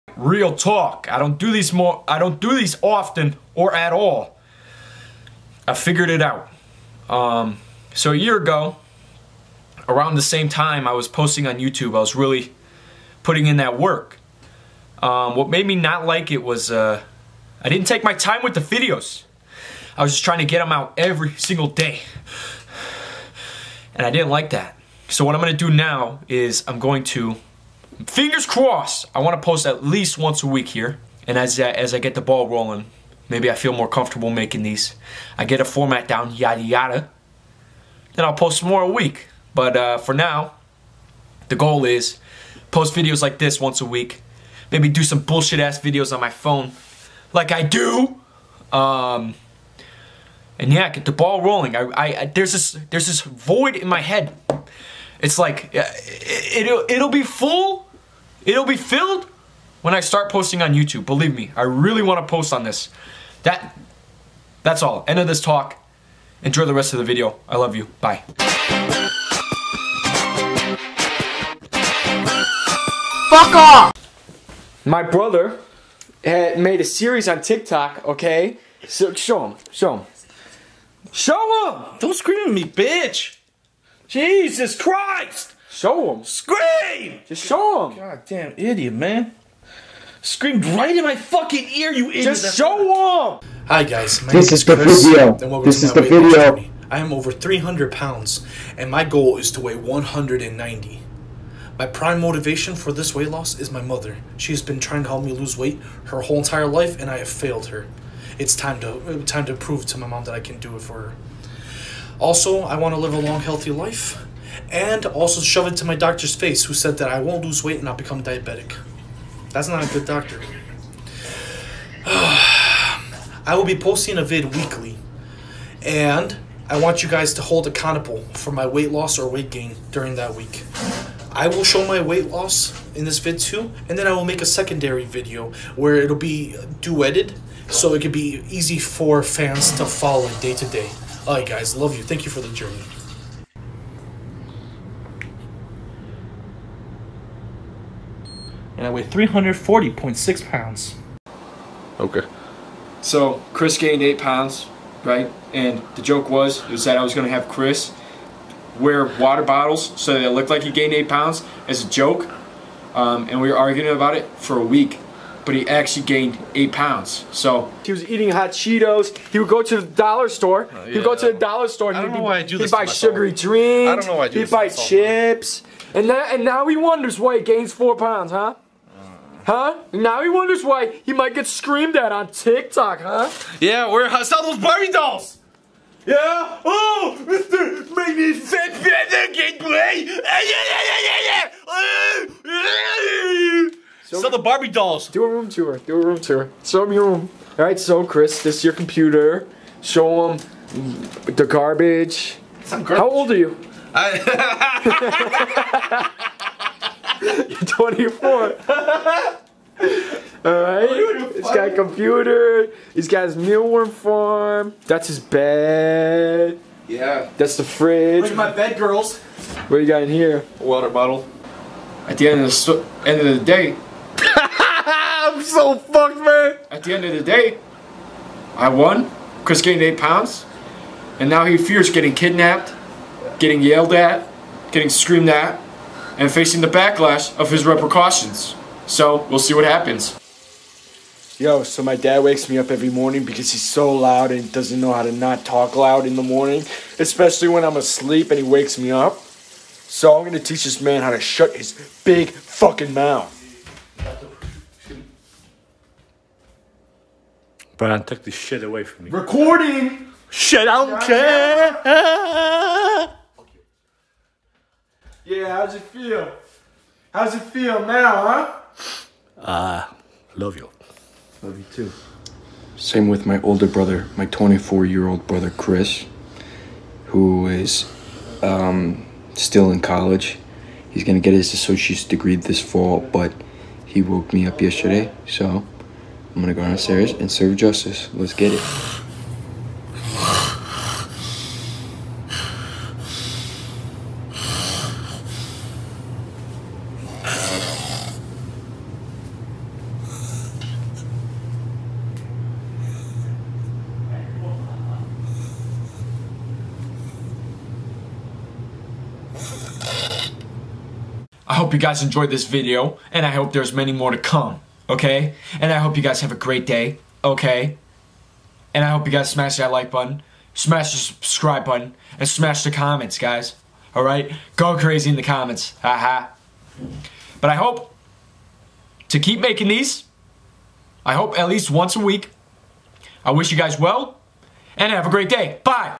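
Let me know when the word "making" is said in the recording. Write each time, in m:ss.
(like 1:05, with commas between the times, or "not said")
0:34, 5:29.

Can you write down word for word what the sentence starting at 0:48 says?
Um, and yeah, get the ball rolling.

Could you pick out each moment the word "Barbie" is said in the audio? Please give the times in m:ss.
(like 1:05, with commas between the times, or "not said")
3:04, 3:14.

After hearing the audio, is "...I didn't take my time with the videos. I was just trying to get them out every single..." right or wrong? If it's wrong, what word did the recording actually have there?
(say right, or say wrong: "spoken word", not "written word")
right.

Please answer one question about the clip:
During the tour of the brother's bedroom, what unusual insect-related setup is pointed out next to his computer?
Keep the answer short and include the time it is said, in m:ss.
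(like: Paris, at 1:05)
Mealworm farm, at 3:33.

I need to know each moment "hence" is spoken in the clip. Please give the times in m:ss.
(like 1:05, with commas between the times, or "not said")
not said.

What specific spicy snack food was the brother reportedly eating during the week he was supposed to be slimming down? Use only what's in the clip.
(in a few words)
Hot Cheetos.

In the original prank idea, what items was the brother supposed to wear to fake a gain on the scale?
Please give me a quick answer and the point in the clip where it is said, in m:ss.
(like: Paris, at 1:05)
Water bottles, at 2:39.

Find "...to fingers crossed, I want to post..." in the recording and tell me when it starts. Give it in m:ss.
0:27.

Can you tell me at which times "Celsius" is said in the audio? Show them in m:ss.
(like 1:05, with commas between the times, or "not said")
not said.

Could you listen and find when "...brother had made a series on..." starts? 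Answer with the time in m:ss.
1:15.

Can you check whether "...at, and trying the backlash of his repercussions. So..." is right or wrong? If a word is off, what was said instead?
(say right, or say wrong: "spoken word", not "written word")
wrong: "facing", not "trying".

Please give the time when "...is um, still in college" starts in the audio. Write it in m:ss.
4:37.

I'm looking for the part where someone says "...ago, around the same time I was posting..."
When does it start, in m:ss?
0:08.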